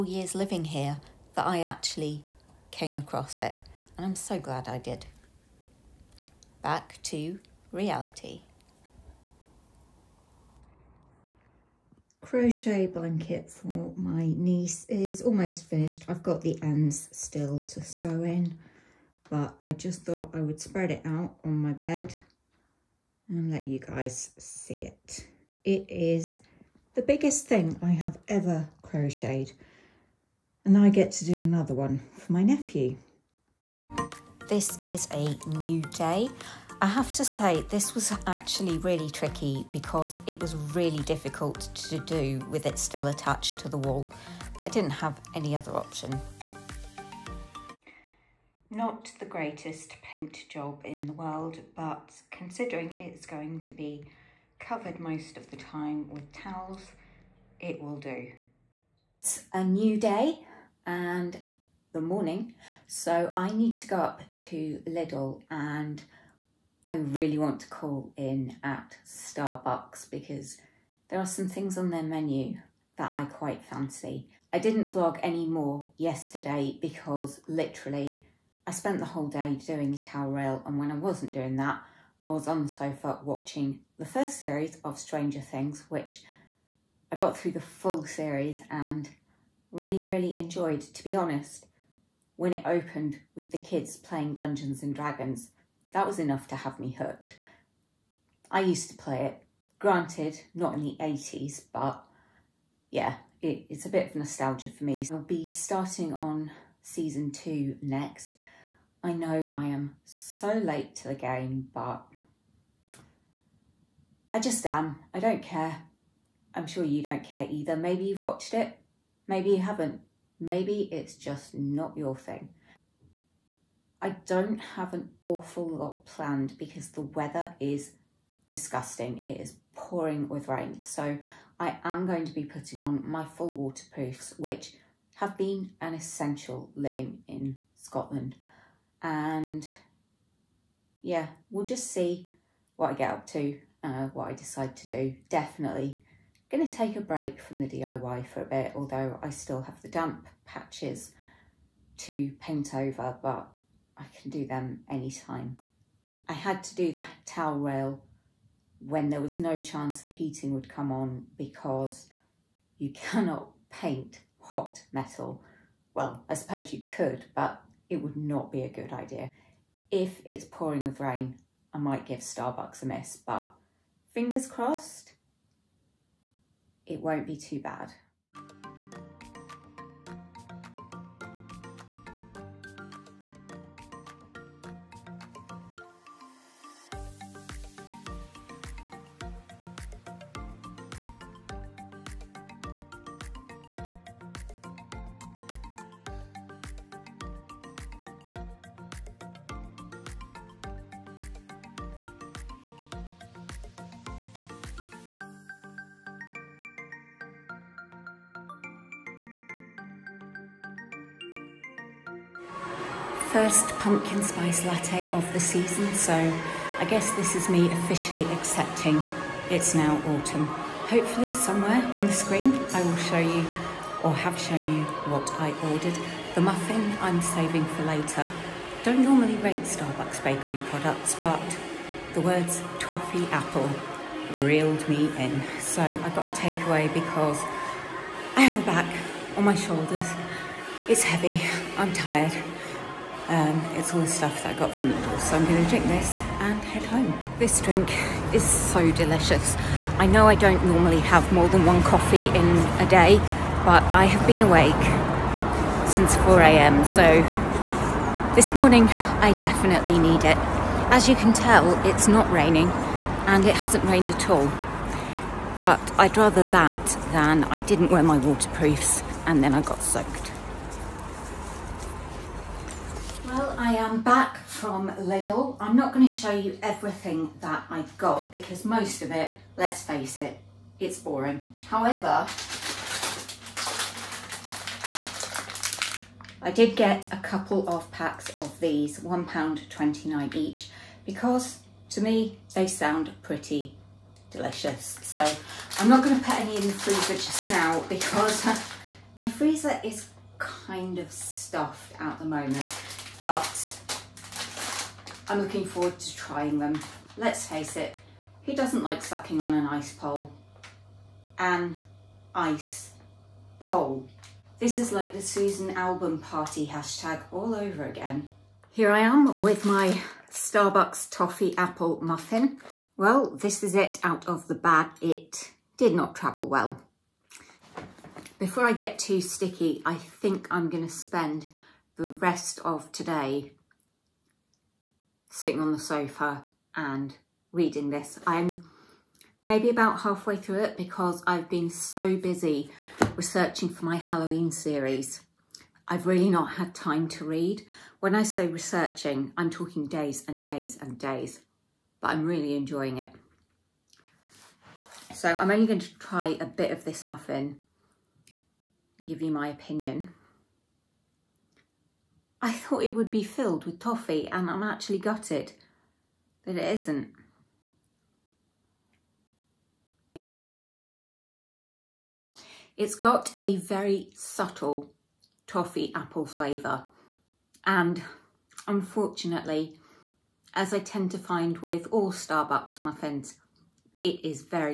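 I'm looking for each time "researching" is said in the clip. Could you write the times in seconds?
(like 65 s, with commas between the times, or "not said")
343 s, 348 s.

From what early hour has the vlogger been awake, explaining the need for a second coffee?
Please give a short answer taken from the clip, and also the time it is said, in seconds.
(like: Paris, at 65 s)
4 a.m., at 256 s.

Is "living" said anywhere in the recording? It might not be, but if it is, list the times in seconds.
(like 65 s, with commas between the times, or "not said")
0 s, 136 s.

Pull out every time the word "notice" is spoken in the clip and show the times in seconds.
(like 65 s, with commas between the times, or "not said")
not said.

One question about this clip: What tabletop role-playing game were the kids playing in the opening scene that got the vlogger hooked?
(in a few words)
Dungeons and Dragons.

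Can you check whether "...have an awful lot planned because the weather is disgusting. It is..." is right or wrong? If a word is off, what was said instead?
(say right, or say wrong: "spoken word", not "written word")
right.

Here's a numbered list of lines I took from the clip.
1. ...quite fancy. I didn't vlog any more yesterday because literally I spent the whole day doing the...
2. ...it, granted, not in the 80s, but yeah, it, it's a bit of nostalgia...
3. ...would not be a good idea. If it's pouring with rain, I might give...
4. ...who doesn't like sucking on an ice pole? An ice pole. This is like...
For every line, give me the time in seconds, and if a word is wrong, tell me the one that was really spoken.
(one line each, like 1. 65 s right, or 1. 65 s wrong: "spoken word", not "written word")
1. 73 s right
2. 99 s right
3. 168 s right
4. 308 s right.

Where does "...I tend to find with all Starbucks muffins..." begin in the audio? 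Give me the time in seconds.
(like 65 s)
380 s.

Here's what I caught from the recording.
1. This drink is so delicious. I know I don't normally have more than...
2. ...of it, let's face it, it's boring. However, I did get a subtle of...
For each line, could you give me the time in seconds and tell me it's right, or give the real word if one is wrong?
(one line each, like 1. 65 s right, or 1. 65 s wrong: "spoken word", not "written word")
1. 247 s right
2. 279 s wrong: "couple", not "subtle".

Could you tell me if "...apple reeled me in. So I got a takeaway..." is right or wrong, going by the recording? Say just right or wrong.
right.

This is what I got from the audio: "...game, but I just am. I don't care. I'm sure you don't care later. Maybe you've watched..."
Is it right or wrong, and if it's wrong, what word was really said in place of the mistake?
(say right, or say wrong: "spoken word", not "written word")
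wrong: "either", not "later".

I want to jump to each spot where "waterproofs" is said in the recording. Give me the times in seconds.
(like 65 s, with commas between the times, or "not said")
133 s, 268 s.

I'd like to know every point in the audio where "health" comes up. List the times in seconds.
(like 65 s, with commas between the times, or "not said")
not said.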